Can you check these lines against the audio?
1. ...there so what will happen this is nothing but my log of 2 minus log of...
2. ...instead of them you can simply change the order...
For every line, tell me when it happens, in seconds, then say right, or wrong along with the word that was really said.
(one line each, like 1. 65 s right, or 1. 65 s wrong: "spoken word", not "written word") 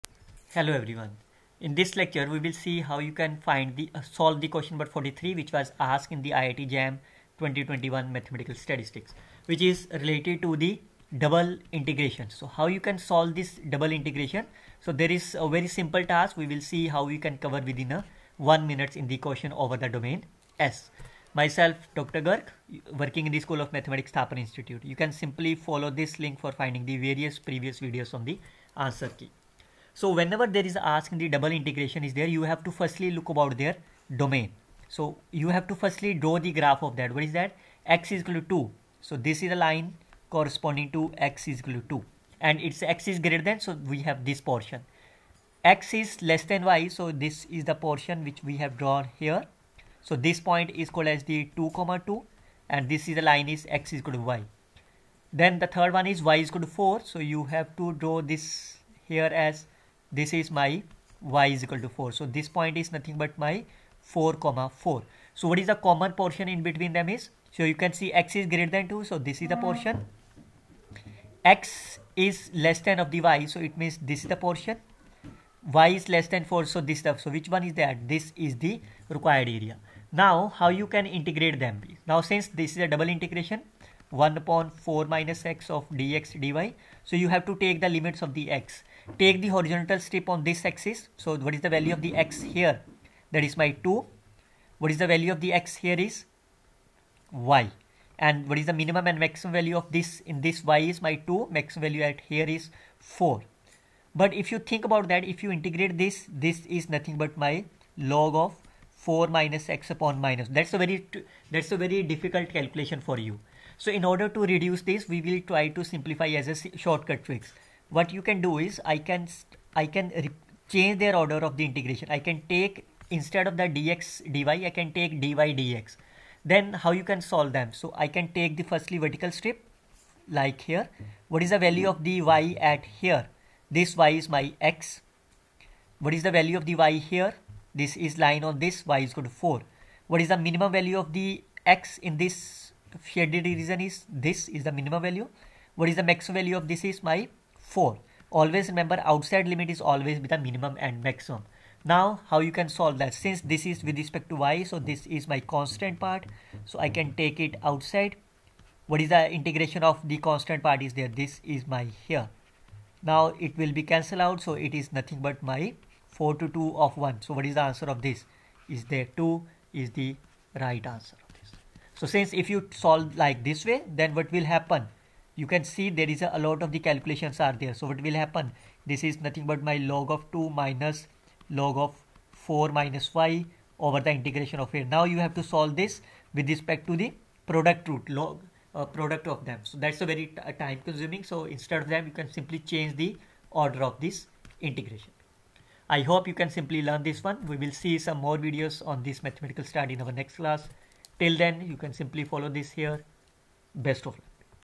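1. 177 s right
2. 191 s right.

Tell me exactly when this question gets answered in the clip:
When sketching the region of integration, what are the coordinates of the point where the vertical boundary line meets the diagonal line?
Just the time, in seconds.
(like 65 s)
51 s.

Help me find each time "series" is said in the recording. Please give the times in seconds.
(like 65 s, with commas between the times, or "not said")
not said.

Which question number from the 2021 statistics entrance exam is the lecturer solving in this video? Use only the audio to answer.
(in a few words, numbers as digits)
43.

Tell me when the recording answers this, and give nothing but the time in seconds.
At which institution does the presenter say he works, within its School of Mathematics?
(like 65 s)
24 s.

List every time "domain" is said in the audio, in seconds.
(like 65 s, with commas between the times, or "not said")
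19 s, 34 s.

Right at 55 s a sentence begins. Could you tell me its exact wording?
Then the third one is y is equal to 4.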